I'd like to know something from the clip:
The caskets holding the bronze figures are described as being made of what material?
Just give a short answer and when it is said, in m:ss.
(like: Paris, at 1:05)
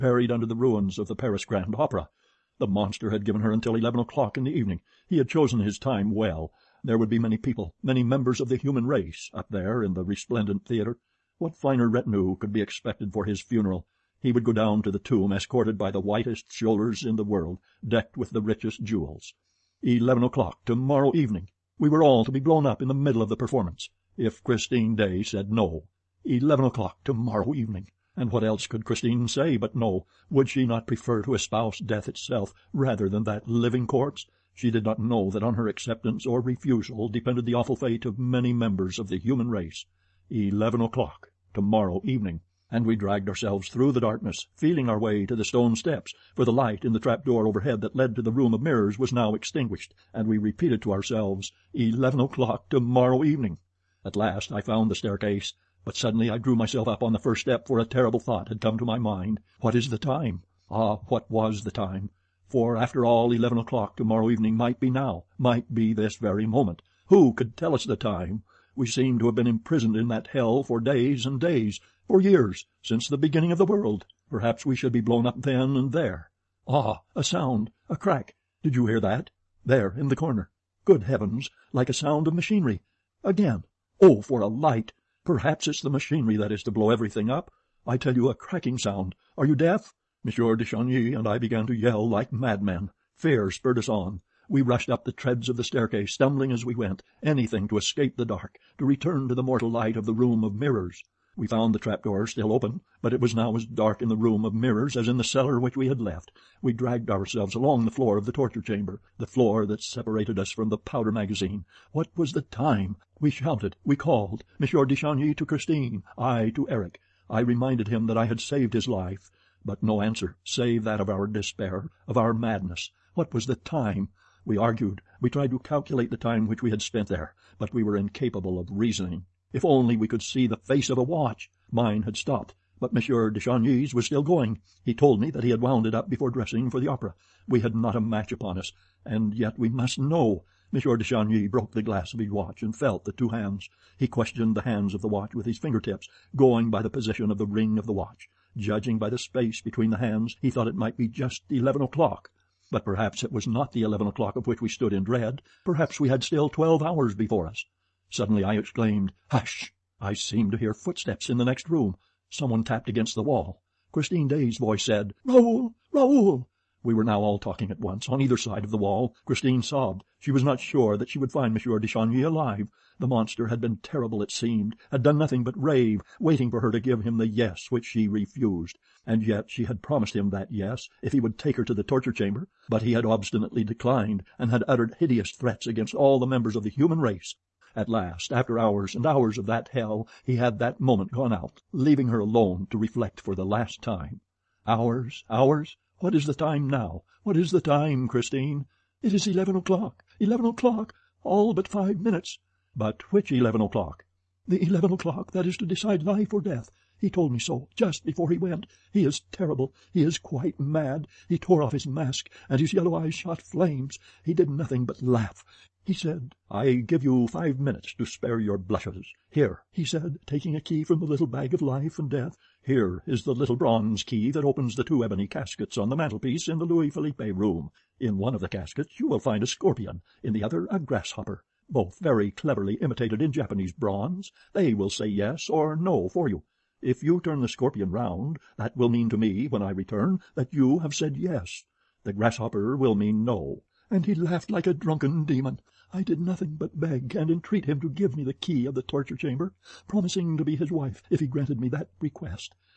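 ebony, at 3:45.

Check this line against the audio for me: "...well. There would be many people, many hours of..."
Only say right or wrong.
wrong.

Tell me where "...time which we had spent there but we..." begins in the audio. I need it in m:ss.
2:06.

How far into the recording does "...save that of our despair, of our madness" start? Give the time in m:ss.
2:00.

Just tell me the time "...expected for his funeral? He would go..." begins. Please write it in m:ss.
0:12.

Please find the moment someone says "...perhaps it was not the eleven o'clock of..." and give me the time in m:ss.
2:32.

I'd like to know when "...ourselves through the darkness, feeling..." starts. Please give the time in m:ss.
0:43.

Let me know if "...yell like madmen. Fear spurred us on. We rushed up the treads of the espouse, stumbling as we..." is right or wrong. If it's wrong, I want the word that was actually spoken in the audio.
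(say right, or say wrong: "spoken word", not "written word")
wrong: "staircase", not "espouse".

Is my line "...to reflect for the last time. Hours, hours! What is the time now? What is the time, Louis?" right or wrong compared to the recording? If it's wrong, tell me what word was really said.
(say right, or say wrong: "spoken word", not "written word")
wrong: "Christine", not "Louis".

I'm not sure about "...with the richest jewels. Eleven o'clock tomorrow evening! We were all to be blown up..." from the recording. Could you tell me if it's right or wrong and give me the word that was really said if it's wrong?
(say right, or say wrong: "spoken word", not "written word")
right.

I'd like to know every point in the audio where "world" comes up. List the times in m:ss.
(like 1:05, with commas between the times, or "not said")
0:17, 1:13.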